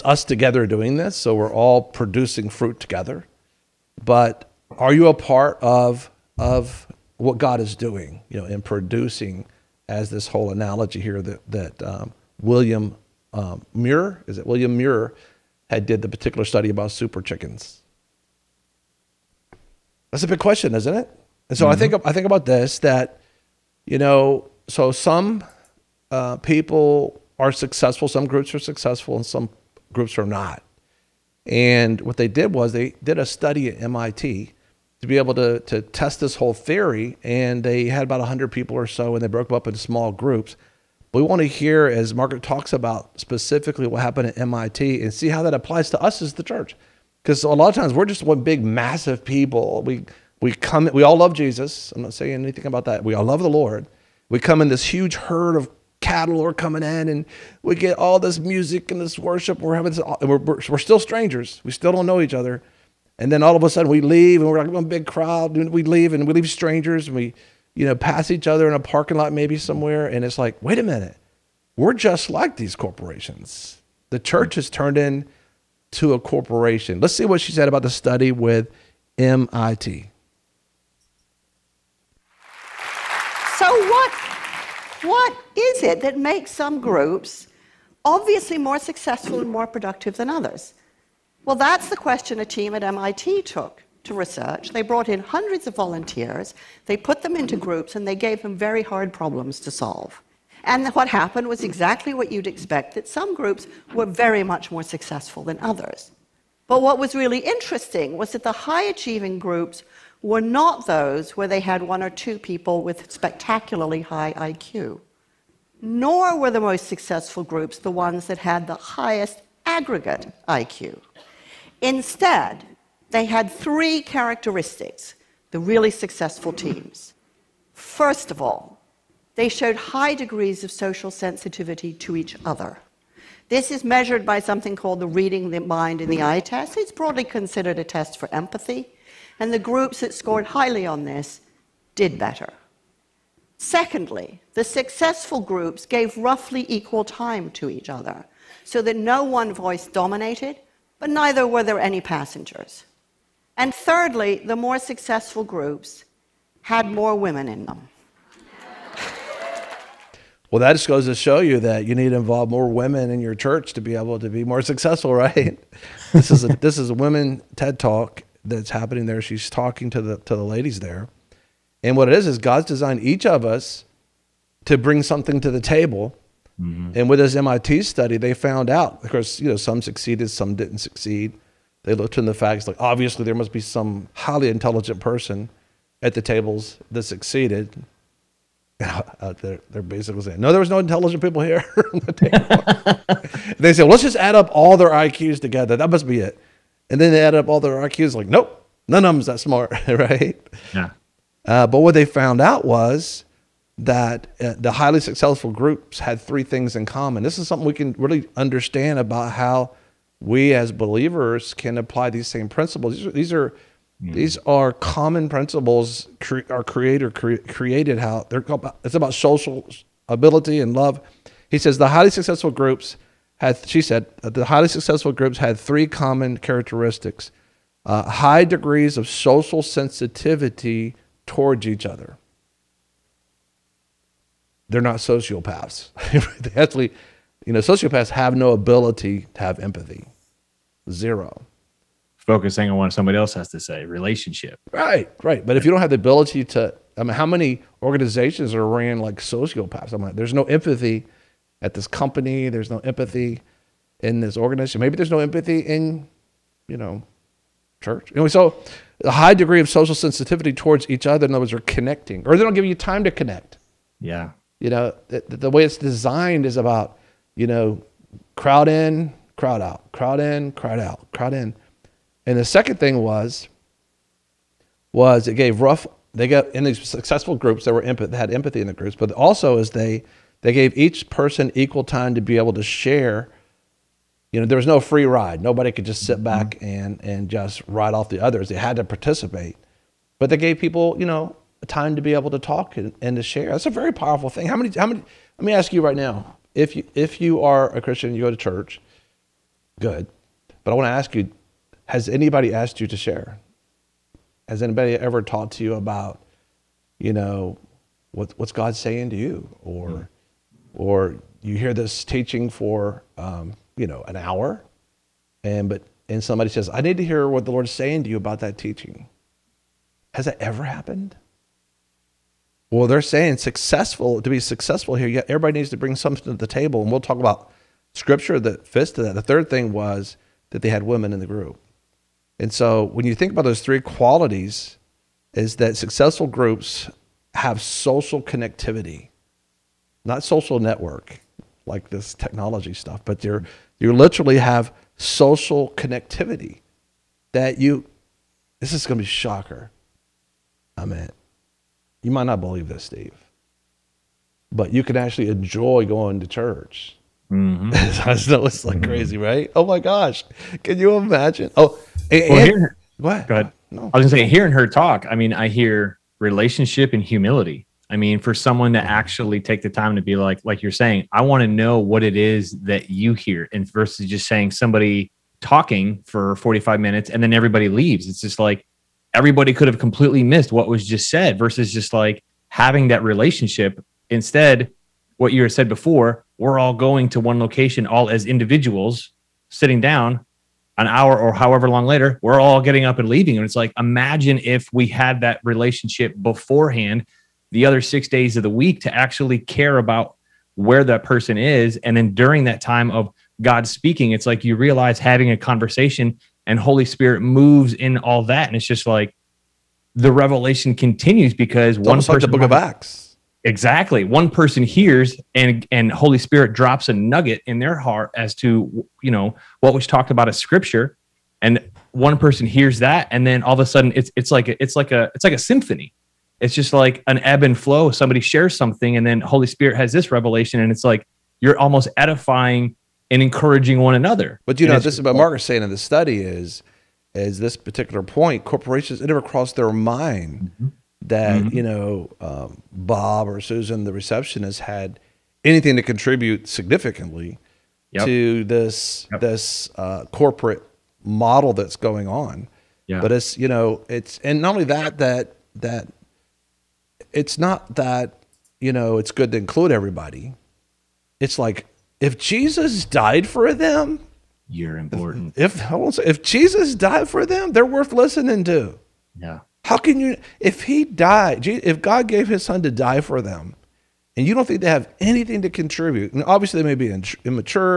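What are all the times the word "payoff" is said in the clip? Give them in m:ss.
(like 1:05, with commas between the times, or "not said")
not said.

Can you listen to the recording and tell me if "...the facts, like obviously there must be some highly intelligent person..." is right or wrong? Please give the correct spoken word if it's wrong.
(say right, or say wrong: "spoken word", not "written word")
right.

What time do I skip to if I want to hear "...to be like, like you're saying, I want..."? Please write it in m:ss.
6:09.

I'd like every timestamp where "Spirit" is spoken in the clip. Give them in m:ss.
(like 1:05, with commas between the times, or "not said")
6:46, 6:56, 7:09.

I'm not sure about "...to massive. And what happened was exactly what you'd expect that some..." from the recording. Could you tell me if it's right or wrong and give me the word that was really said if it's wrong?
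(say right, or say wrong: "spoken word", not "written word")
wrong: "solve", not "massive".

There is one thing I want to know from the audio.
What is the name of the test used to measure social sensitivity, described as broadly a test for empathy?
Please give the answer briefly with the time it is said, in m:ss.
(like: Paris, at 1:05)
Reading the mind in the eye test, at 2:15.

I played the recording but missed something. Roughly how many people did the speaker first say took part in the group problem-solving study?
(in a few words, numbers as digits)
100.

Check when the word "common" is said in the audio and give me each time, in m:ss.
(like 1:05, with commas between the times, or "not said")
3:26, 3:34, 3:45.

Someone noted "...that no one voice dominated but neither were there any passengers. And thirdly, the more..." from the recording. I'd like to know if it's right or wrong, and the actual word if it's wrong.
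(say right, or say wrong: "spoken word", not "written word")
right.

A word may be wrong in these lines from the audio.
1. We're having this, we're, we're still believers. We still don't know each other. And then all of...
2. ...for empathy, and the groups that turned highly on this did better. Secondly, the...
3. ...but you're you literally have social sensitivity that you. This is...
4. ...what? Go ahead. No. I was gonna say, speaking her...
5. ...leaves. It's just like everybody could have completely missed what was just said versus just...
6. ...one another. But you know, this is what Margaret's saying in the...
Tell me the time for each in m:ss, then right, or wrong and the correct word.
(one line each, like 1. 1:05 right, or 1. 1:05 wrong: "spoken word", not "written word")
1. 0:59 wrong: "strangers", not "believers"
2. 2:18 wrong: "scored", not "turned"
3. 5:43 wrong: "connectivity", not "sensitivity"
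4. 6:02 wrong: "hearing", not "speaking"
5. 6:17 right
6. 7:13 right.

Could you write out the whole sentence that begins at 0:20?
That's a big question, isn't it?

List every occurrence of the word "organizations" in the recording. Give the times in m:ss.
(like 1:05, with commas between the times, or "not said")
4:07, 4:14.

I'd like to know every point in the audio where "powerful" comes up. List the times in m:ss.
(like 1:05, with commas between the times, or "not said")
4:53.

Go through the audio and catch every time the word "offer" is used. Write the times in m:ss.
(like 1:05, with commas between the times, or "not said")
not said.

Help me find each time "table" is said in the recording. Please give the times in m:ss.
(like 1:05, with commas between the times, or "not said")
2:55, 3:06, 5:26.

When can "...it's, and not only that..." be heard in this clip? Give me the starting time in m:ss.
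7:33.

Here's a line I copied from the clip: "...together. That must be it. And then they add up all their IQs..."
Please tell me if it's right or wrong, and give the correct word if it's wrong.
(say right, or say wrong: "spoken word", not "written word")
right.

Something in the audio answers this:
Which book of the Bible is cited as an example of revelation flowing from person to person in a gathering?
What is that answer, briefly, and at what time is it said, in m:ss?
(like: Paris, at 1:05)
Acts, at 6:52.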